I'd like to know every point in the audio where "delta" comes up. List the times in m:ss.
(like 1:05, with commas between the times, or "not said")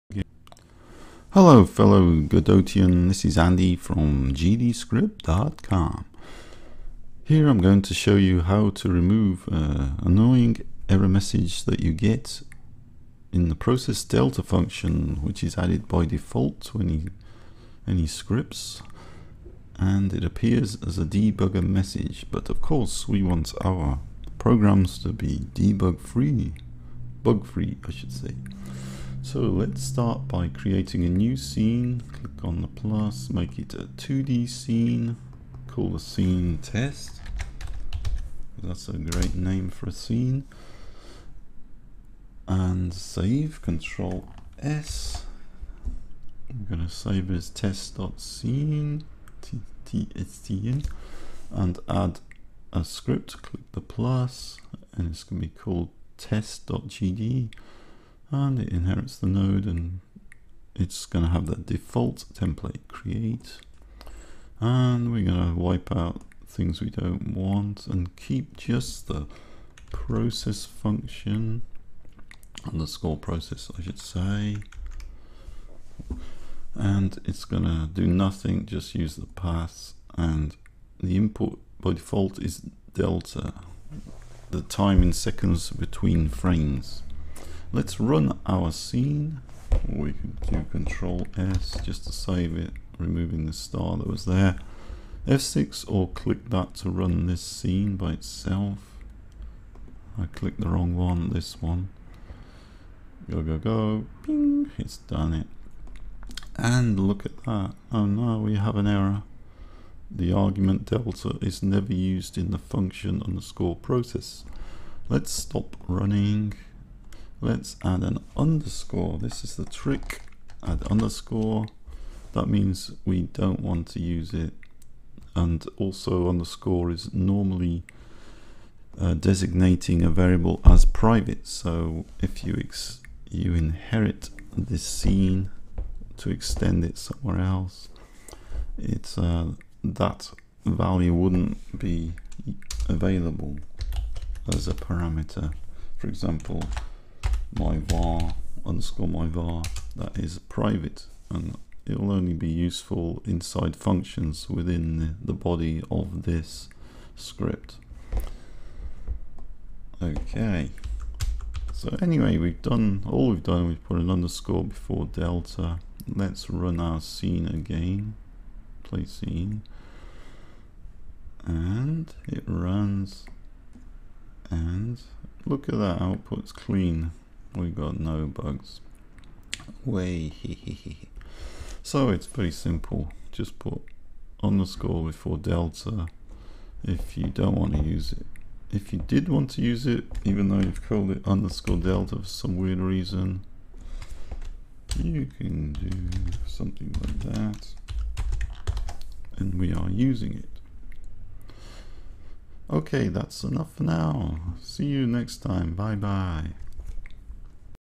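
0:14, 1:22, 1:50, 2:45, 3:05, 3:11.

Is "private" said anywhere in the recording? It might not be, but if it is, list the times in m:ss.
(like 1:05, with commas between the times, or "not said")
2:10, 2:30.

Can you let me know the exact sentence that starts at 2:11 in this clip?
So if you you inherit this scene to extend it somewhere else, it's uh, that value wouldn't be available as a parameter.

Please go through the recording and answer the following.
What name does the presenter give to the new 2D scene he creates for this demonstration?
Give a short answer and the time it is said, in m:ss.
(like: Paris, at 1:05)
test, at 0:35.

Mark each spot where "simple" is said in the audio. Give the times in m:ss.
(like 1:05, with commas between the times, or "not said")
3:02.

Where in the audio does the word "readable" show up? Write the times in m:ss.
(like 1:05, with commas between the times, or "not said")
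not said.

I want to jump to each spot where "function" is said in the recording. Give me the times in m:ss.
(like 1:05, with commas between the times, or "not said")
0:14, 1:10, 1:52, 2:33.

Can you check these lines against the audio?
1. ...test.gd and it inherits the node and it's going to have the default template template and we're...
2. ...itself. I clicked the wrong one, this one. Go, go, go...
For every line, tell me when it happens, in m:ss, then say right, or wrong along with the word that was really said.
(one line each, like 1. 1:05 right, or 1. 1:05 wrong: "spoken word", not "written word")
1. 0:56 wrong: "create", not "template"
2. 1:38 right.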